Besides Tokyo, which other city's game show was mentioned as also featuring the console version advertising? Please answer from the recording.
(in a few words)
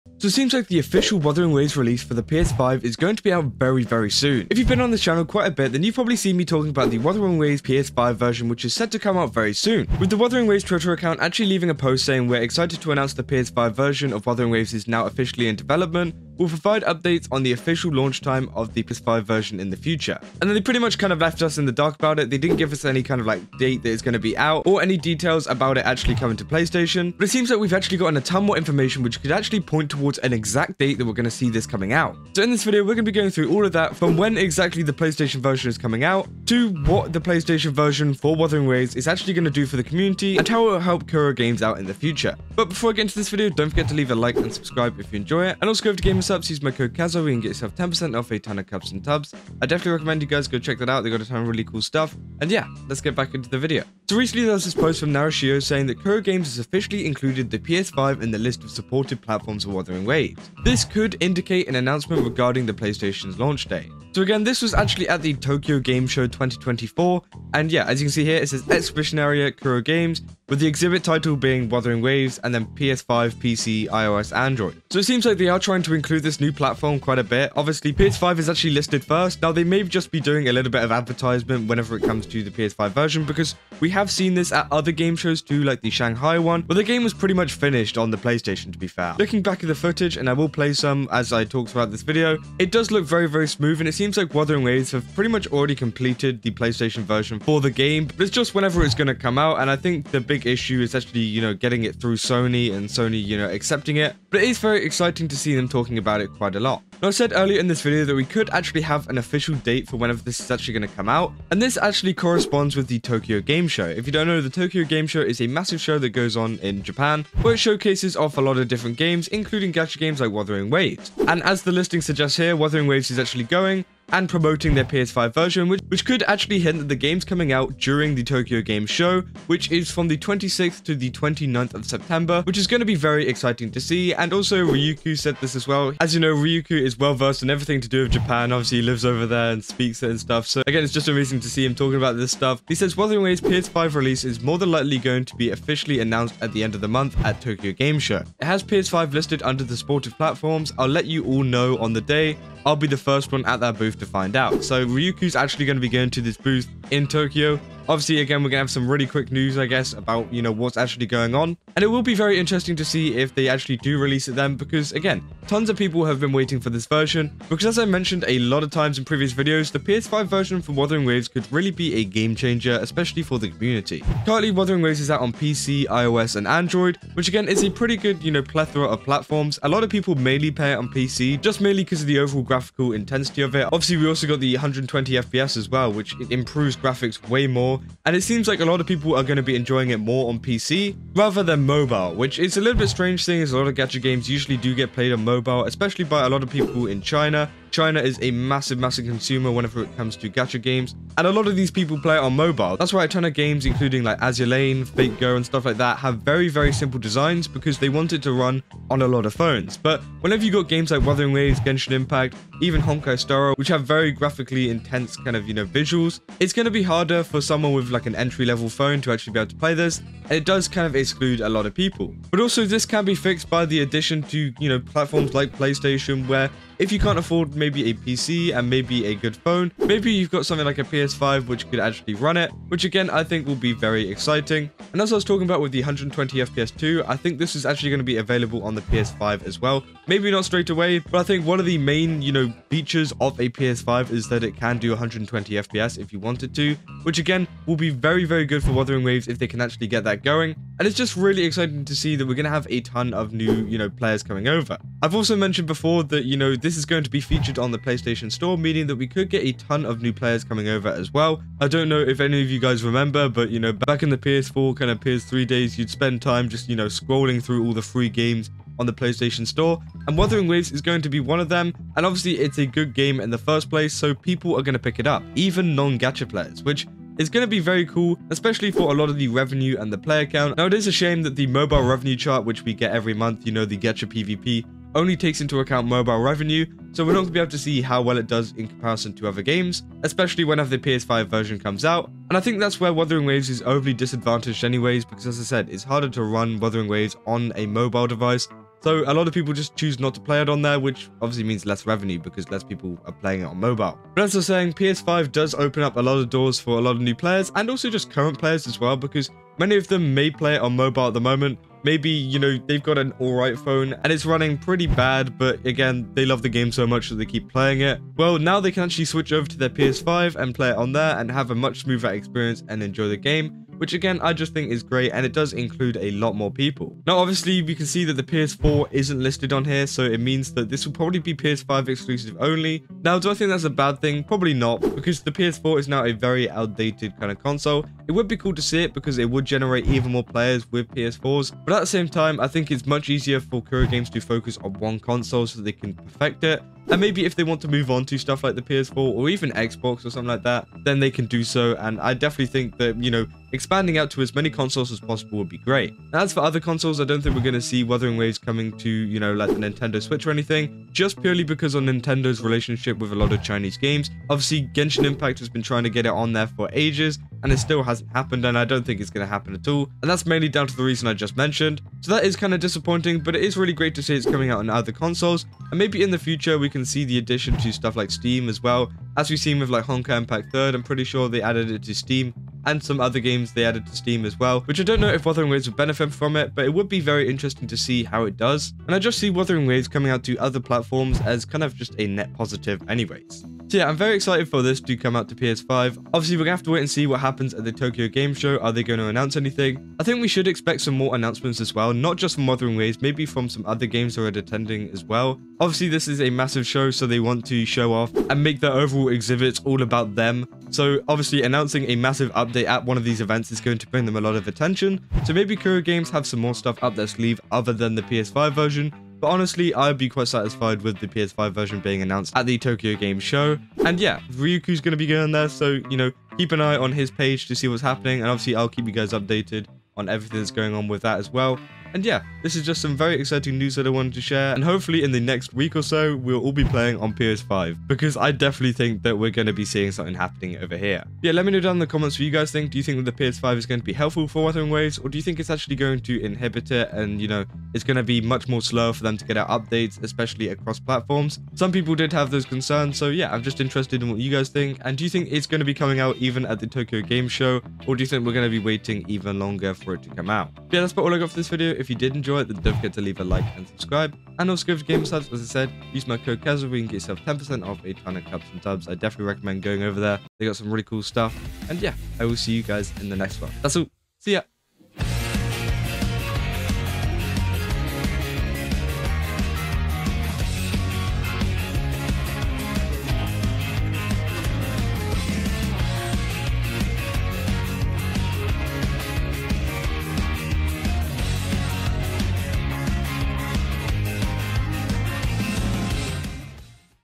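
Shanghai.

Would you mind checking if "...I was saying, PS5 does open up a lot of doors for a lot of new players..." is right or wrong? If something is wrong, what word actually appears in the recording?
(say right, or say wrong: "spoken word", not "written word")
right.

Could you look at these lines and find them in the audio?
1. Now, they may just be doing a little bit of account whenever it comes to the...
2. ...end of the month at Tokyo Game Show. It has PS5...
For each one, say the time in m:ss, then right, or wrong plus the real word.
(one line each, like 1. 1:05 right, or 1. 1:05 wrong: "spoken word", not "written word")
1. 1:19 wrong: "advertisement", not "account"
2. 2:26 right.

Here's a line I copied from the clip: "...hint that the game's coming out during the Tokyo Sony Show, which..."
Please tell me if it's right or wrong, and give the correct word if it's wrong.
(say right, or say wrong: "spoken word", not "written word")
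wrong: "Game", not "Sony".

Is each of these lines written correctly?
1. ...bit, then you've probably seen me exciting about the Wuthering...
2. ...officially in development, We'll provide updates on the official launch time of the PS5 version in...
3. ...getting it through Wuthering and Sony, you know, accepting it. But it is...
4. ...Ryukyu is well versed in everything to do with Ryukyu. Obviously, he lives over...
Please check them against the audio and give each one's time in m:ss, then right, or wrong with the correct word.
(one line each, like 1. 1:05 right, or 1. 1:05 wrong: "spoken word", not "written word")
1. 0:05 wrong: "talking", not "exciting"
2. 0:15 right
3. 1:41 wrong: "Sony", not "Wuthering"
4. 2:16 wrong: "Japan", not "Ryukyu".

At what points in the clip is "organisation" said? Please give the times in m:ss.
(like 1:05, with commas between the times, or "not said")
not said.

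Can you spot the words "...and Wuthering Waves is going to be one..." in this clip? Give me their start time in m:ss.
4:30.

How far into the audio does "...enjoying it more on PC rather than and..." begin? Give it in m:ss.
3:09.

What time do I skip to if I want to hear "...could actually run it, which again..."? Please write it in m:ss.
3:51.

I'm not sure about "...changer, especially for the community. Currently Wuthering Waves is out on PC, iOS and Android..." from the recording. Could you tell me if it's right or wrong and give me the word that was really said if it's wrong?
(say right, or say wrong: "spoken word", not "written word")
right.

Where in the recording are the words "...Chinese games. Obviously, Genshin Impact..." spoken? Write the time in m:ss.
6:03.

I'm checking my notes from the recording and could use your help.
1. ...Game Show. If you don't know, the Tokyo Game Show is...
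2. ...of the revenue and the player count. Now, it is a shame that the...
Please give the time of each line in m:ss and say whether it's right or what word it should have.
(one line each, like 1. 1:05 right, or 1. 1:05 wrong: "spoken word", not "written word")
1. 1:53 right
2. 4:39 right.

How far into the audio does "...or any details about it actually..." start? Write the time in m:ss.
0:24.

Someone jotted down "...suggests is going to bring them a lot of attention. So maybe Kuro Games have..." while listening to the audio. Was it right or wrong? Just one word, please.
wrong.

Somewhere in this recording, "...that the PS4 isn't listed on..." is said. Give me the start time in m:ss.
5:28.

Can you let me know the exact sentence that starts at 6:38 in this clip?
Are they going to announce anything?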